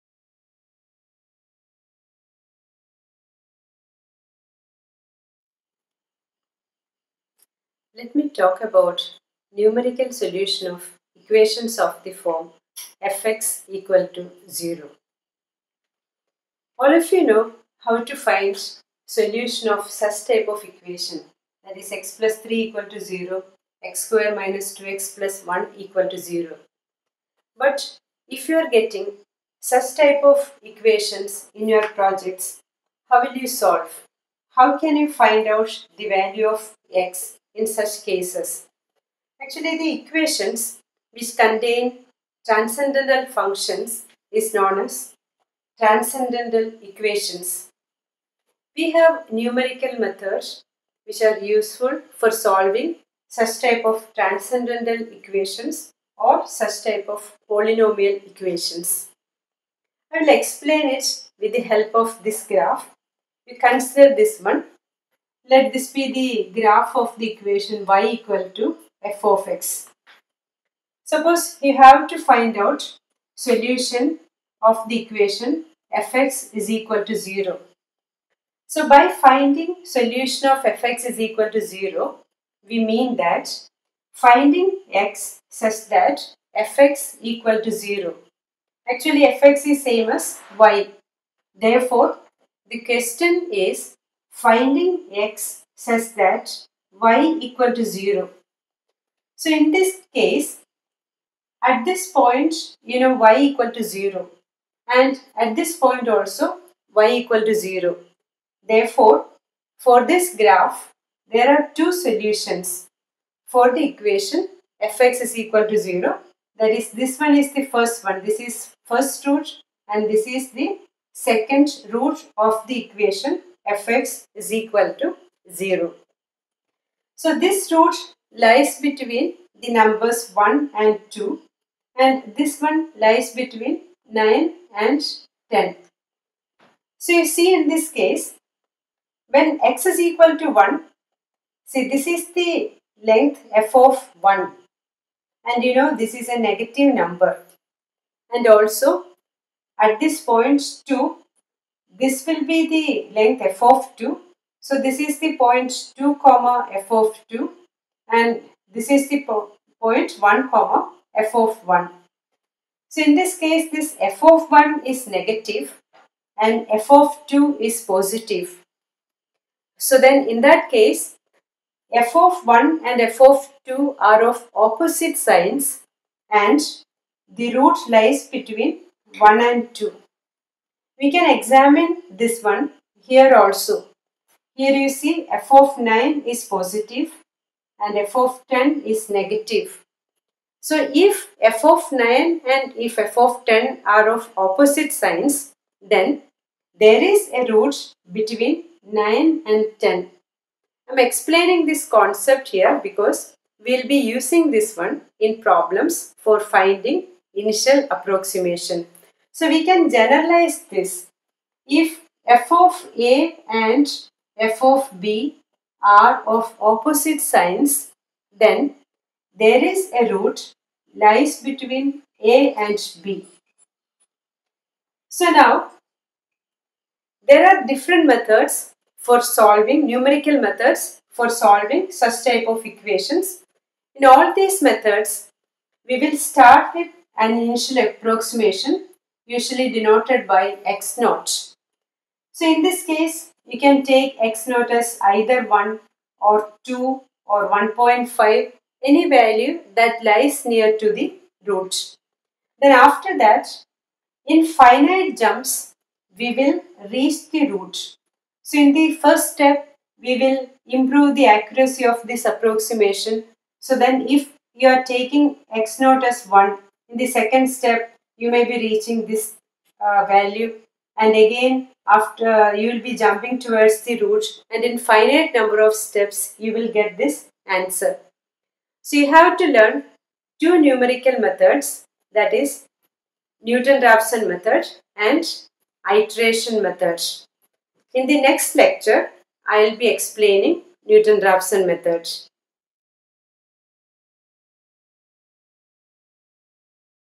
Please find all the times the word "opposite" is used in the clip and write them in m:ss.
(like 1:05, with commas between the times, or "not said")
2:54, 3:14, 3:36.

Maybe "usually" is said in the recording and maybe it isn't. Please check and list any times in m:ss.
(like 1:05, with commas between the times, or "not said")
3:59.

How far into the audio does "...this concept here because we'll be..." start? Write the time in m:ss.
3:21.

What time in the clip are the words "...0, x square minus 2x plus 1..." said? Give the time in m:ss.
0:22.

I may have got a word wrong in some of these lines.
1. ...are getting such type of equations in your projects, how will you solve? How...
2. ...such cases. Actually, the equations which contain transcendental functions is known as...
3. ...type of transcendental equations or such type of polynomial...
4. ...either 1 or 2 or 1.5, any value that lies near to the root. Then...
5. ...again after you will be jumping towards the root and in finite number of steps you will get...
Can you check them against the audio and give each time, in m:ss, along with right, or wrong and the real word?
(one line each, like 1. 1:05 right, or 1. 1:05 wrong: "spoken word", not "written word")
1. 0:28 right
2. 0:37 right
3. 0:53 right
4. 4:05 right
5. 4:31 right.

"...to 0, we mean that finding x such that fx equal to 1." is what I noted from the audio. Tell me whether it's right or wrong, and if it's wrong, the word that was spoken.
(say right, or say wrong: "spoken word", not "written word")
wrong: "0", not "1".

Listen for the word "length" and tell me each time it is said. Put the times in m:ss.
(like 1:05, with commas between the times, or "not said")
2:23, 2:33.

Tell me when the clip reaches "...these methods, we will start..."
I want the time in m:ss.
3:54.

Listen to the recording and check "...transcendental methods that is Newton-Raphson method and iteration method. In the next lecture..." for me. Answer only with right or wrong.
wrong.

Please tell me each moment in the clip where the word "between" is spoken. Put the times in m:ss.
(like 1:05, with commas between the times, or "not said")
2:08, 2:13, 2:58, 3:18, 3:41.